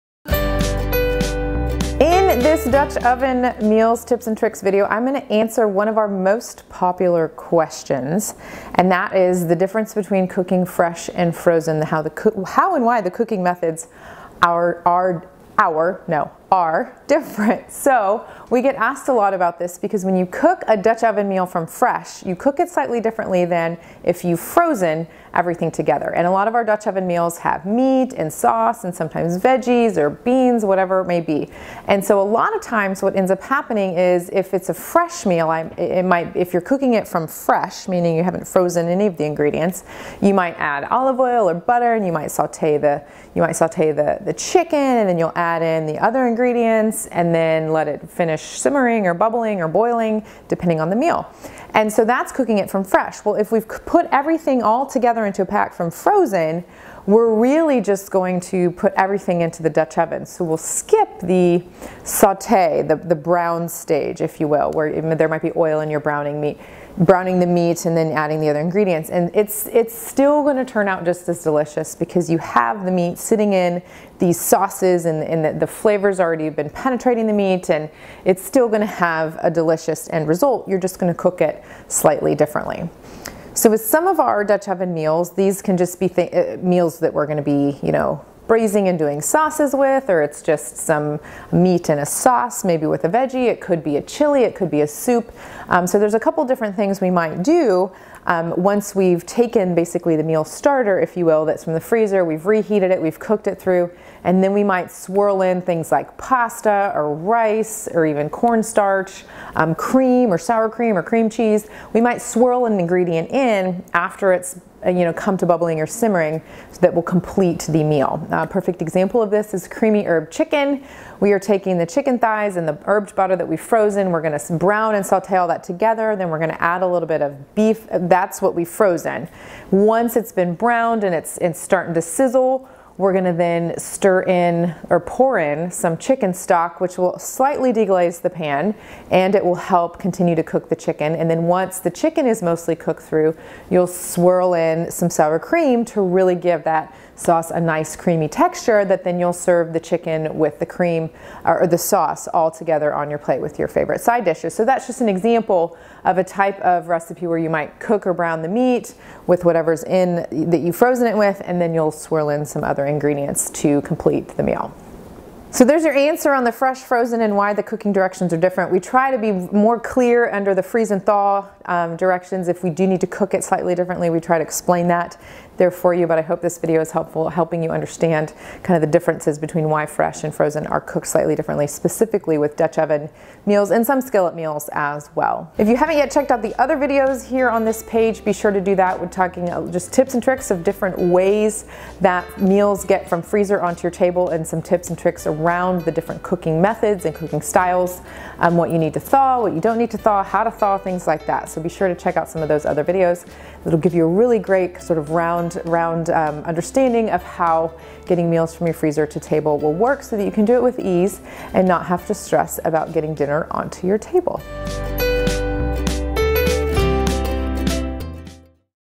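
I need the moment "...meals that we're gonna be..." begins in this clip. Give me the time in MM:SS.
01:26.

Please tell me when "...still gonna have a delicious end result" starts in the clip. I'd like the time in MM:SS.
01:18.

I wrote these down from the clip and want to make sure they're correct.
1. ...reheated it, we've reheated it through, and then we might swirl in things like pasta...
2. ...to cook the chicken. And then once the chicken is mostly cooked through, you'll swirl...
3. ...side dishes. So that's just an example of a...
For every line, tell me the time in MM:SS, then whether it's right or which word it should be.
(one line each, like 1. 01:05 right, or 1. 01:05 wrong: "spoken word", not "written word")
1. 01:42 wrong: "cooked", not "reheated"
2. 02:20 right
3. 02:34 right.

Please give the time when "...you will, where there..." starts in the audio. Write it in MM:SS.
01:04.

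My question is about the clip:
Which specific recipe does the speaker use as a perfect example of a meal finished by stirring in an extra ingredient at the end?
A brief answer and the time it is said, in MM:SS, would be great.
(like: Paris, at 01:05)
creamy herb chicken, at 01:59.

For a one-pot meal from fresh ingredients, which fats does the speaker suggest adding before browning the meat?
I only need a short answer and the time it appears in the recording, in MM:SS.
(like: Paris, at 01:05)
olive oil or butter, at 00:40.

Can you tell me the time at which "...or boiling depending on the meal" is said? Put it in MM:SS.
00:49.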